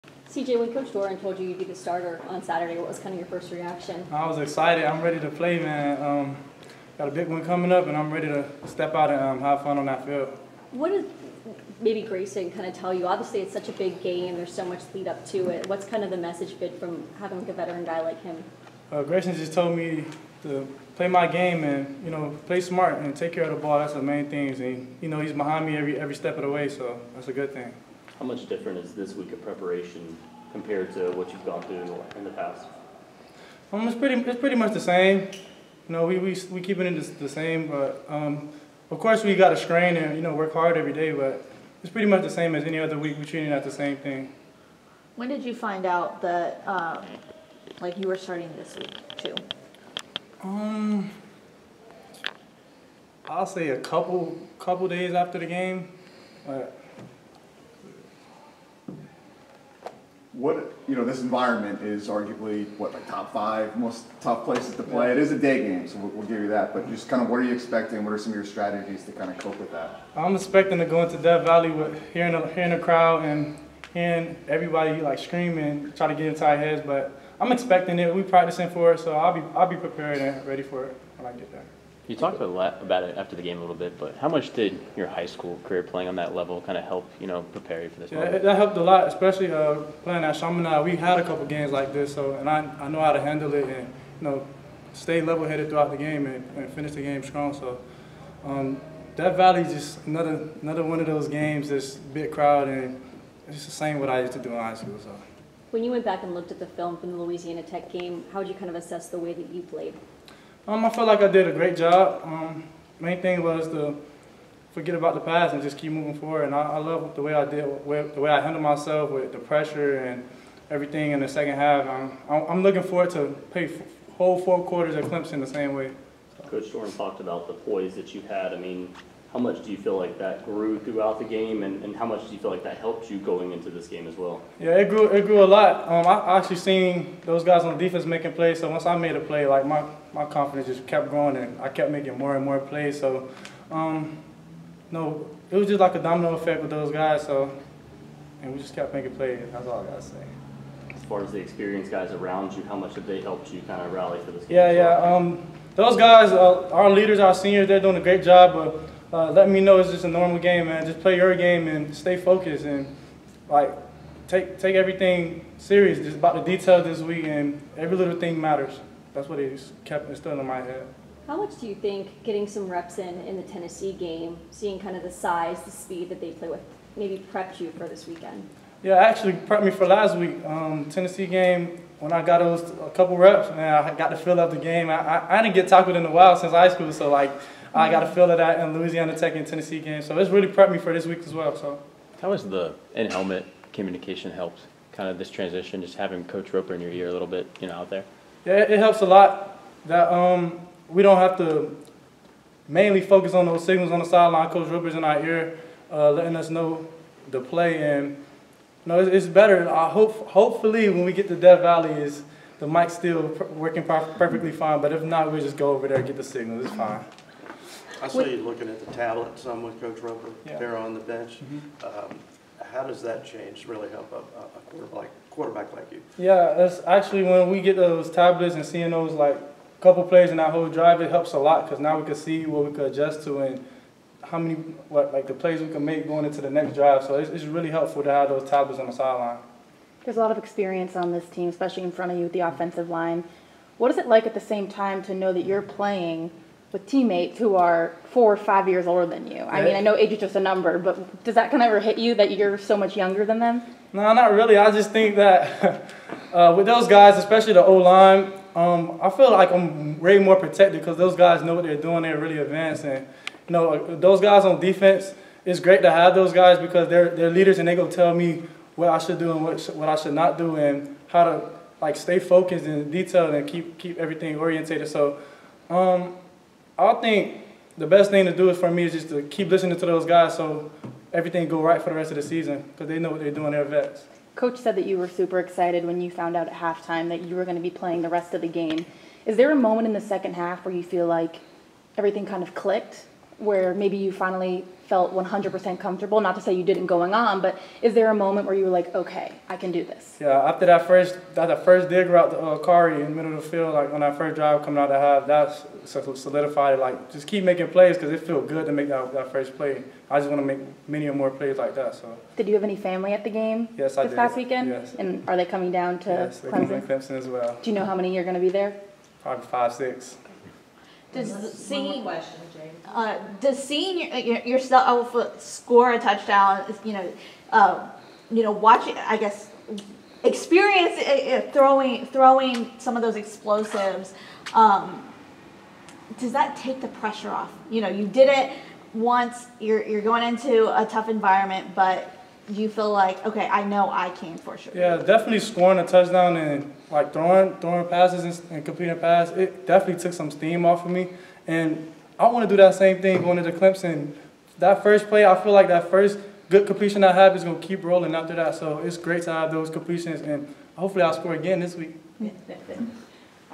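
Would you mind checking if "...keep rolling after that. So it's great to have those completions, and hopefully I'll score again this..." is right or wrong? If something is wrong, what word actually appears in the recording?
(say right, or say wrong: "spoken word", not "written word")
right.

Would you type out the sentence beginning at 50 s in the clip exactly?
Um, I'll say a couple couple days after the game.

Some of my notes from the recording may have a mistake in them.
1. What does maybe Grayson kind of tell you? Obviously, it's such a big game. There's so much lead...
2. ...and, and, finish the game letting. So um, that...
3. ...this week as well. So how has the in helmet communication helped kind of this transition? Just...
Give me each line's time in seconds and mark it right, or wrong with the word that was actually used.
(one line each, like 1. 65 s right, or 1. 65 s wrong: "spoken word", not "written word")
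1. 10 s right
2. 96 s wrong: "strong", not "letting"
3. 190 s right.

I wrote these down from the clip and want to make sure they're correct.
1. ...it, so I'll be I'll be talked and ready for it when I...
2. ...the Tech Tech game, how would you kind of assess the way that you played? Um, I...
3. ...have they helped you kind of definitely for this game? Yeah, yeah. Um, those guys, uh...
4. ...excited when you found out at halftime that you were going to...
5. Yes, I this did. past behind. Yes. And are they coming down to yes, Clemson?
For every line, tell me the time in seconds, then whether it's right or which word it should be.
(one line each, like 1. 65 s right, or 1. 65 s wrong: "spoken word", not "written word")
1. 78 s wrong: "prepared", not "talked"
2. 107 s wrong: "Louisiana", not "Tech"
3. 152 s wrong: "rally", not "definitely"
4. 285 s right
5. 313 s wrong: "weekend", not "behind".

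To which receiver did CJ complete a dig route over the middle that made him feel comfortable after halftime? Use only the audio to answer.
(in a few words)
Kari.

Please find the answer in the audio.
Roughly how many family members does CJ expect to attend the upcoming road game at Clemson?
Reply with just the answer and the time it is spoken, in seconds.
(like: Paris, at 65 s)
5 or 6, at 319 s.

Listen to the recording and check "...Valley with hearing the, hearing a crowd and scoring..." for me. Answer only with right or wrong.
wrong.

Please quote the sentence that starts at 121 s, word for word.
Um, I'm, I'm looking forward to play whole four quarters at Clemson the same way.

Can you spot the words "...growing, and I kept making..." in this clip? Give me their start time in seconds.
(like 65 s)
141 s.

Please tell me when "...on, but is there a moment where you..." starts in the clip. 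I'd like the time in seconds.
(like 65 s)
297 s.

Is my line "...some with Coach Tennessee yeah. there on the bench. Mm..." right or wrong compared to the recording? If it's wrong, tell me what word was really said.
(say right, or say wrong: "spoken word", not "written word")
wrong: "Roper", not "Tennessee".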